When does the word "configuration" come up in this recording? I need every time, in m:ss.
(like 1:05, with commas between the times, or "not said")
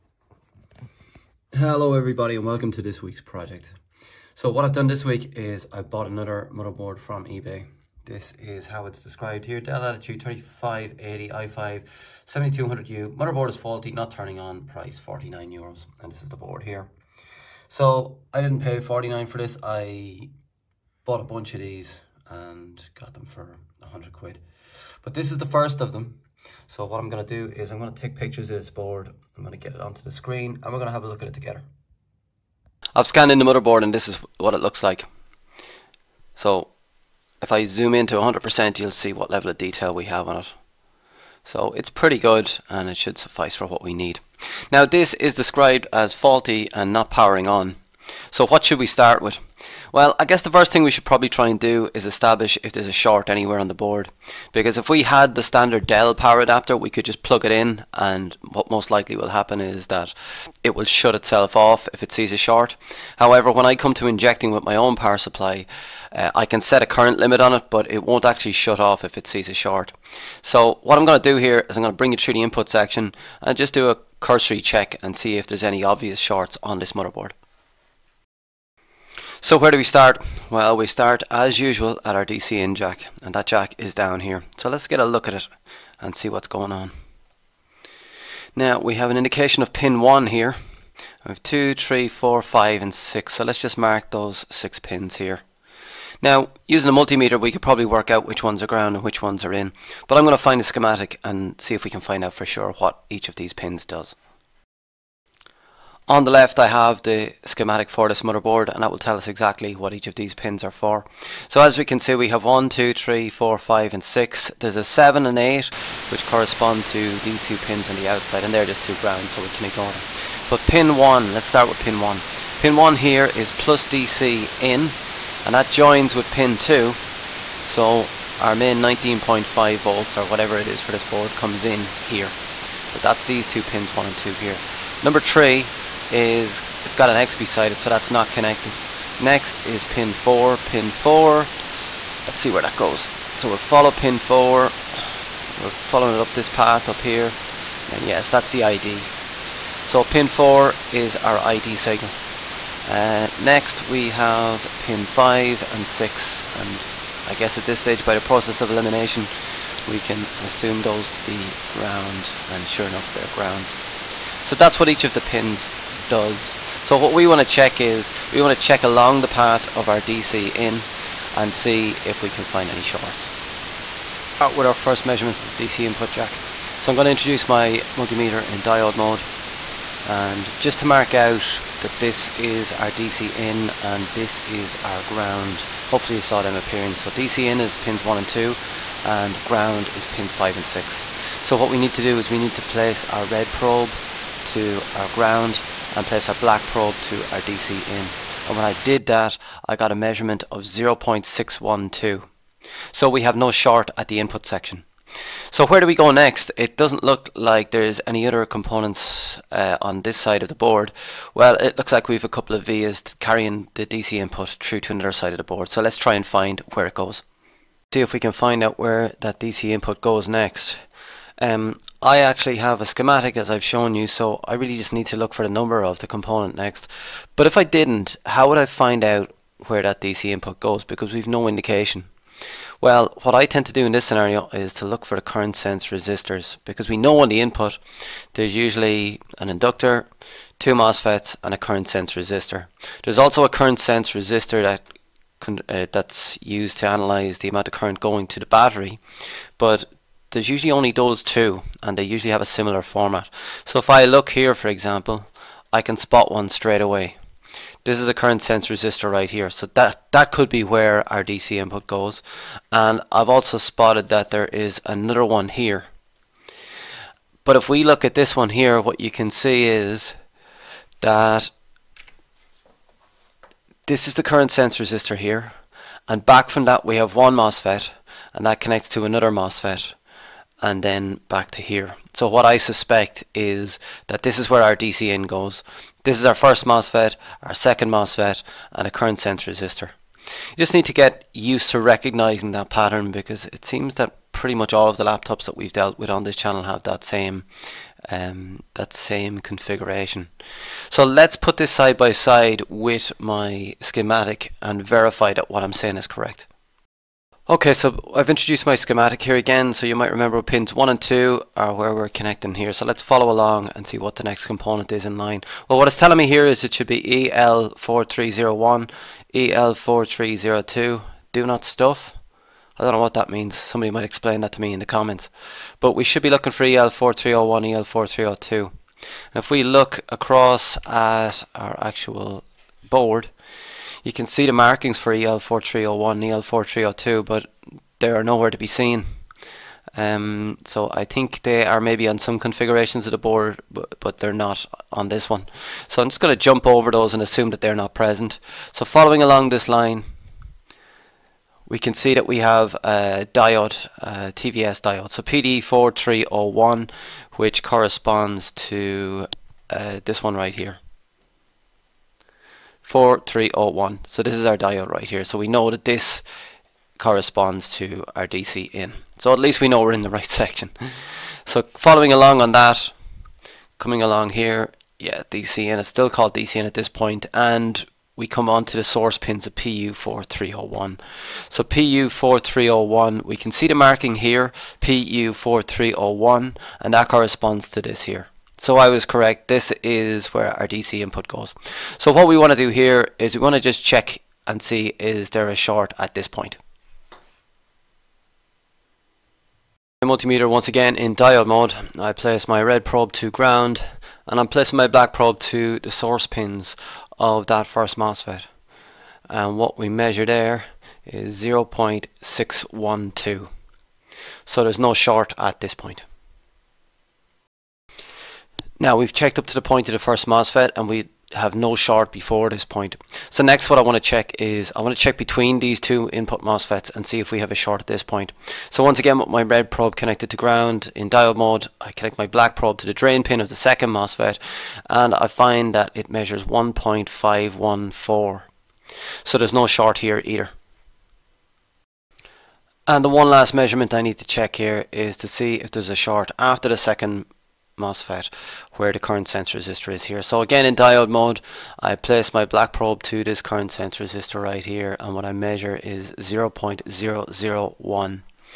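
4:59, 5:42.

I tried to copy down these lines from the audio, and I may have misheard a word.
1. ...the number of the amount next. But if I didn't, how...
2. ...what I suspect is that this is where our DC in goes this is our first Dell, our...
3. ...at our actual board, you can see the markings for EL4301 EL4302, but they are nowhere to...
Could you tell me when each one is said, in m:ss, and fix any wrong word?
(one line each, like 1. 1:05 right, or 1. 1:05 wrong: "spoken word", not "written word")
1. 3:45 wrong: "component", not "amount"
2. 4:42 wrong: "MOSFET", not "Dell"
3. 5:30 right.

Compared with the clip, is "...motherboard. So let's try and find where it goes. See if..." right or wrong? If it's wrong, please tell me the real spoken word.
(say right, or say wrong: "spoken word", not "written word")
wrong: "board", not "motherboard".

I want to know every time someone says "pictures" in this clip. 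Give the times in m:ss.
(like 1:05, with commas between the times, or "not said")
0:28.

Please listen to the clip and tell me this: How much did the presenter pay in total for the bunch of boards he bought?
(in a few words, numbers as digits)
100 quid.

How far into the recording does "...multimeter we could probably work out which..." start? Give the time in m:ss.
1:36.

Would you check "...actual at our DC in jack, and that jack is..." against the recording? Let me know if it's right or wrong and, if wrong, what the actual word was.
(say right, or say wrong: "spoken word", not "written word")
wrong: "usual", not "actual".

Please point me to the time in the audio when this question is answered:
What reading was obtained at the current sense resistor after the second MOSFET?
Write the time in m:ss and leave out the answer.
7:36.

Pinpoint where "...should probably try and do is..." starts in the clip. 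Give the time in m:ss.
0:50.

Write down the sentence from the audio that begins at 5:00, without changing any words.
So let's put this side by side with my schematic and verify that what I'm saying is correct.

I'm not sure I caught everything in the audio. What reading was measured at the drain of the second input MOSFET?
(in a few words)
1.514.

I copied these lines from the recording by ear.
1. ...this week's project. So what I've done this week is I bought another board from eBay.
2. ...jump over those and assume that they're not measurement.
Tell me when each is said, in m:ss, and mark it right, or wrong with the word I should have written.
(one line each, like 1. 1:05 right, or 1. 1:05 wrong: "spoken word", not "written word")
1. 0:02 wrong: "motherboard", not "board"
2. 5:46 wrong: "present", not "measurement".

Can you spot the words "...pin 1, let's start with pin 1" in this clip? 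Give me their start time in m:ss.
2:00.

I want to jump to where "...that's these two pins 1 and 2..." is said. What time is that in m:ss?
2:12.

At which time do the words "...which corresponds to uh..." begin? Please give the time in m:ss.
5:57.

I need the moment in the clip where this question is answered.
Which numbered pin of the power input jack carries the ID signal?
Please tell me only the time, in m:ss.
2:30.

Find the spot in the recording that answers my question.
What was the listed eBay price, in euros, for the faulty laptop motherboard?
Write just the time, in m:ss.
0:14.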